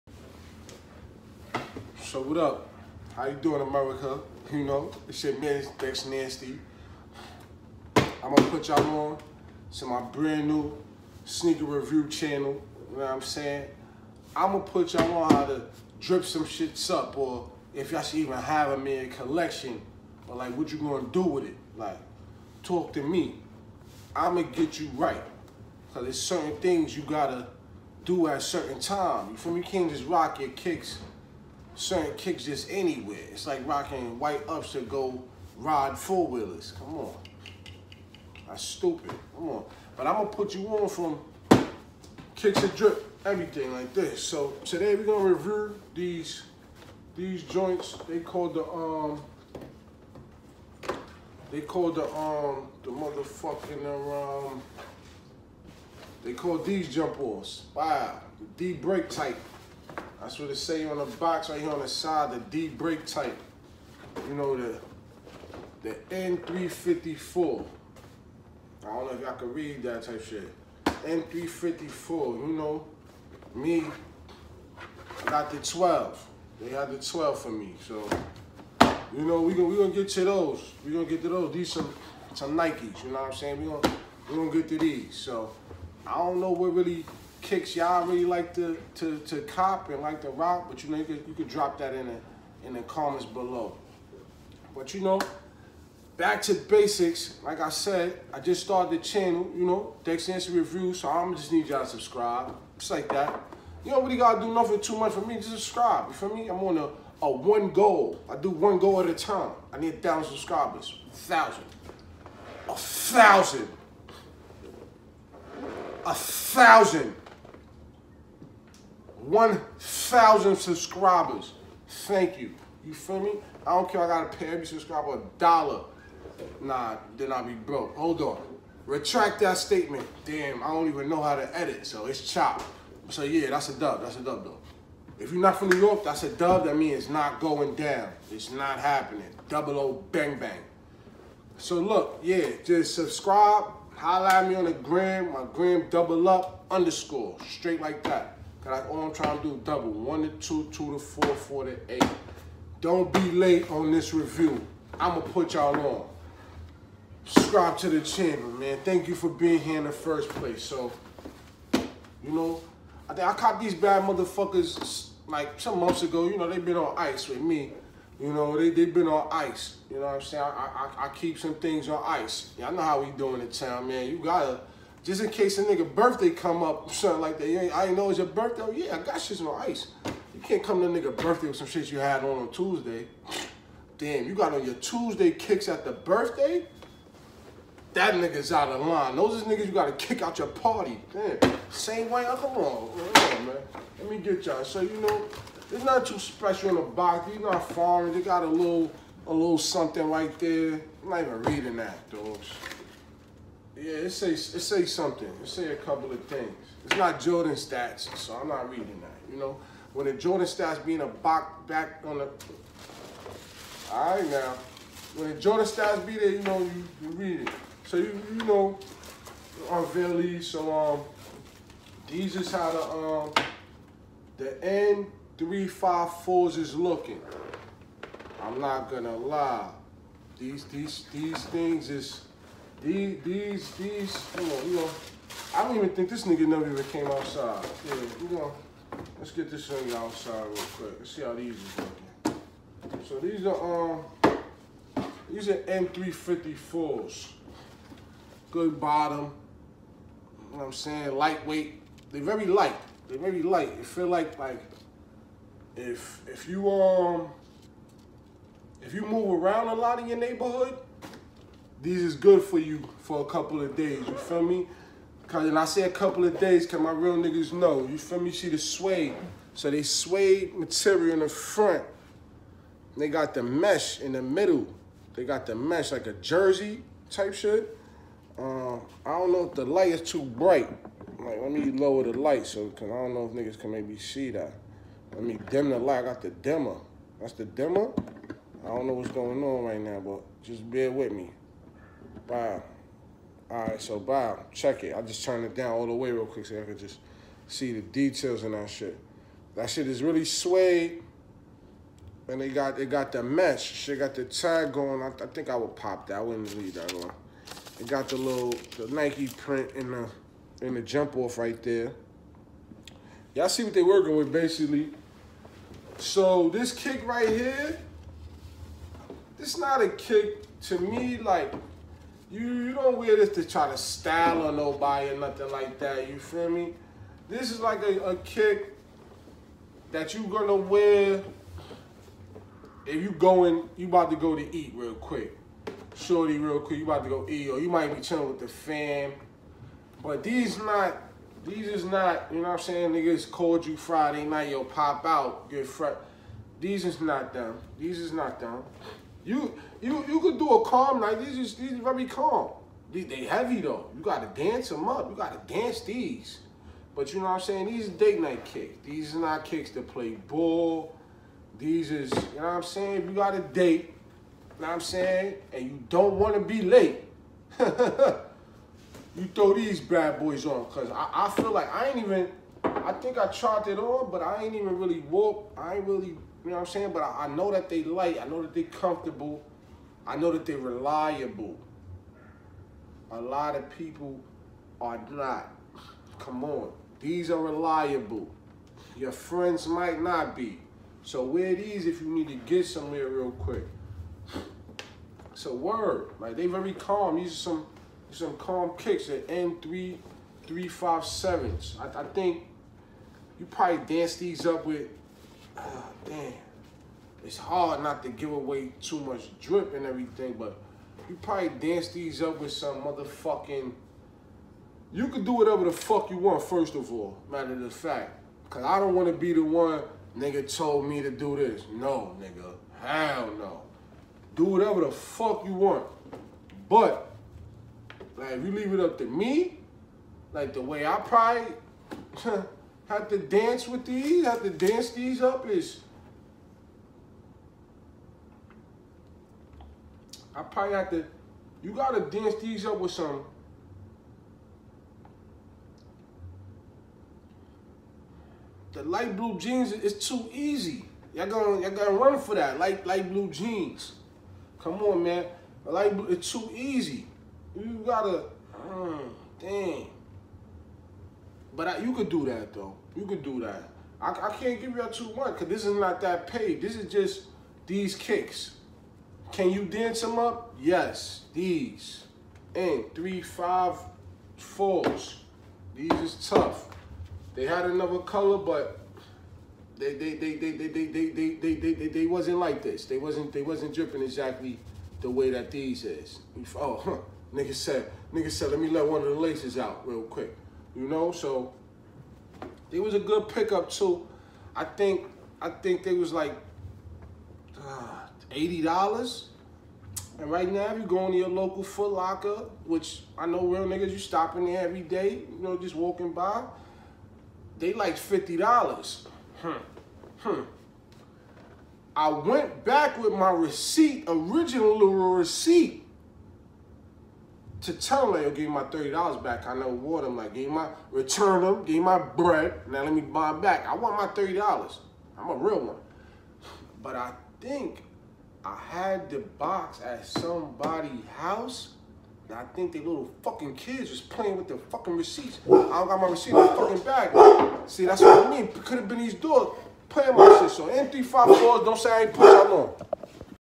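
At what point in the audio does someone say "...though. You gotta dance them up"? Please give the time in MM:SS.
05:53.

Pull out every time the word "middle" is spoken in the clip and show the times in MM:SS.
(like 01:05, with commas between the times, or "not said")
04:34.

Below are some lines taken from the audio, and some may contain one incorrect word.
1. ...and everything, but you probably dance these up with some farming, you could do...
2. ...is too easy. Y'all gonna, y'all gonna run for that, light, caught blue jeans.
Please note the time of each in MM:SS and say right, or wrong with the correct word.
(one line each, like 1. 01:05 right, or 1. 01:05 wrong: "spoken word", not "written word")
1. 06:49 wrong: "motherfucking", not "farming"
2. 07:29 wrong: "light", not "caught".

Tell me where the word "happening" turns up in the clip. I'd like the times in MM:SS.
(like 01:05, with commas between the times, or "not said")
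02:18.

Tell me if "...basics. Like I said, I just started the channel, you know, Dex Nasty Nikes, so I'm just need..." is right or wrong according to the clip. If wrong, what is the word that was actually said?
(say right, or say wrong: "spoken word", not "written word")
wrong: "Review", not "Nikes".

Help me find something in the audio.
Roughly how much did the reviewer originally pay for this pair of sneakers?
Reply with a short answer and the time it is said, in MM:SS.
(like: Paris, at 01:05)
$80, at 08:18.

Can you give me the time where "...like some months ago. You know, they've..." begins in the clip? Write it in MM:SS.
02:45.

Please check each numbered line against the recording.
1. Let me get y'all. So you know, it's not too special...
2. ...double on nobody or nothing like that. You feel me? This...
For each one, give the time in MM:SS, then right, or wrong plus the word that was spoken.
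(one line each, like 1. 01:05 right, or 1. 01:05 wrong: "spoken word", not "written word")
1. 03:13 right
2. 05:23 wrong: "style", not "double".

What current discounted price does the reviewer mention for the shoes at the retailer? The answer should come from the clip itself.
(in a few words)
$50.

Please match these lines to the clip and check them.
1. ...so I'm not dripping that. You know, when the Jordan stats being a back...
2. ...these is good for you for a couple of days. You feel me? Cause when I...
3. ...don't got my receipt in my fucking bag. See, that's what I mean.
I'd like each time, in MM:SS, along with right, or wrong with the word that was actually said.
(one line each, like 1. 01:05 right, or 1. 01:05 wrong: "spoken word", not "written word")
1. 03:28 wrong: "reading", not "dripping"
2. 04:21 right
3. 08:55 right.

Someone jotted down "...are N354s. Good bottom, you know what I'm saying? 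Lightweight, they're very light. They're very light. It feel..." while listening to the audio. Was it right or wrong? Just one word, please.
right.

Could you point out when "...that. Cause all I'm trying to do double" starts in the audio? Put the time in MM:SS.
02:28.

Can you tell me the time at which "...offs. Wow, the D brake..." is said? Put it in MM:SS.
00:57.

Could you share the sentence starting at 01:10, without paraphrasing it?
N354, you know, me, I got the 12.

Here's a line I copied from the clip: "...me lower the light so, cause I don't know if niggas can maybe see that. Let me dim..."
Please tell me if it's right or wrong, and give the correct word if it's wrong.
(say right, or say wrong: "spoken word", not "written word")
right.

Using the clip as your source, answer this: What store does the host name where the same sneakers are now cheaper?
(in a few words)
Foot Locker.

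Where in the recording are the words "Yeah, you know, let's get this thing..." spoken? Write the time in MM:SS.
03:57.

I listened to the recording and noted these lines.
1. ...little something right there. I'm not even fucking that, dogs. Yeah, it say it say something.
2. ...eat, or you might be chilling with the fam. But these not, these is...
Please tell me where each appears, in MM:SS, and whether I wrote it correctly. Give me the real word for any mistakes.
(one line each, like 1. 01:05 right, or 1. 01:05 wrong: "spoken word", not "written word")
1. 03:19 wrong: "reading", not "fucking"
2. 05:37 right.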